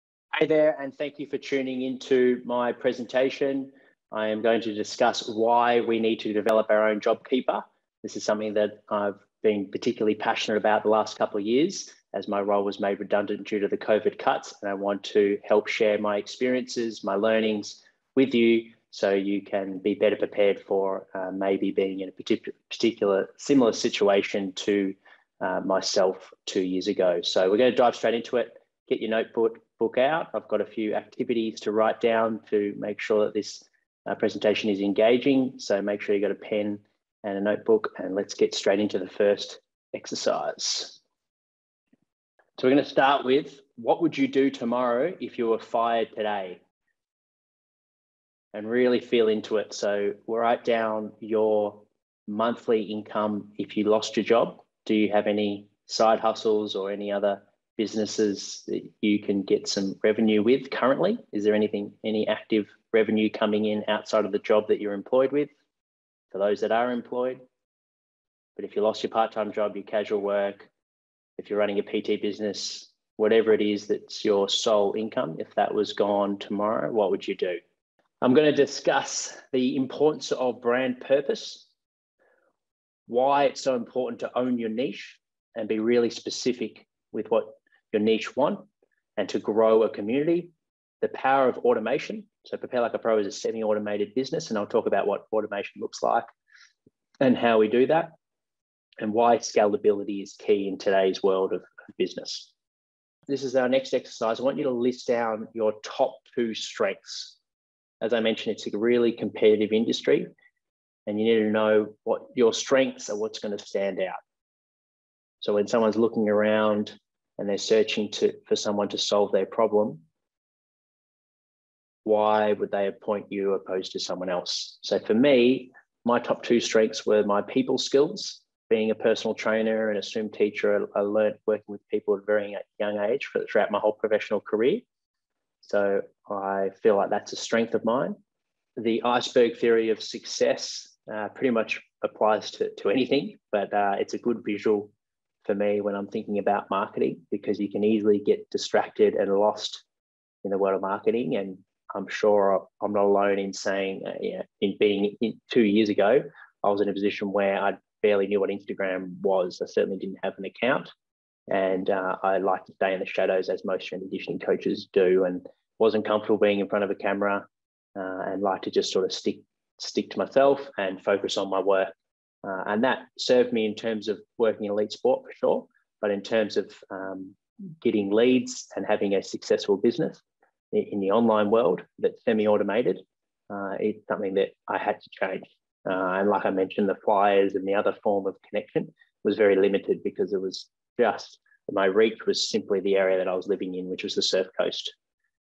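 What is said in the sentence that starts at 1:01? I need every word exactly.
Is there anything, any active revenue coming in outside of the job that you're employed with for those that are employed?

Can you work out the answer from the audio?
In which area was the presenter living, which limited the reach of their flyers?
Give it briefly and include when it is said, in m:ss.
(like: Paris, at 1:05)
the Surf Coast, at 3:14.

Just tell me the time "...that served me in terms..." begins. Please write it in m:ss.
2:52.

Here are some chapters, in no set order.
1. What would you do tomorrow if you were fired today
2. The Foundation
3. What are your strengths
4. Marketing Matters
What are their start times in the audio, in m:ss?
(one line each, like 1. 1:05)
1. 0:42
2. 1:18
3. 1:43
4. 2:18.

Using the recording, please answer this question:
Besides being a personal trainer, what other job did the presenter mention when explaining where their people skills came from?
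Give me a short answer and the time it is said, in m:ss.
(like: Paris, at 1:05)
swim teacher, at 2:10.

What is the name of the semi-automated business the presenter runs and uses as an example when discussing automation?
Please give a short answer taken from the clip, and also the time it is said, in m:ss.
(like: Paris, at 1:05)
Prepare Like a Pro, at 1:32.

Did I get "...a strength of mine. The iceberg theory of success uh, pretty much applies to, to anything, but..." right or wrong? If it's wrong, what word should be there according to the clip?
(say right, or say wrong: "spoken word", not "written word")
right.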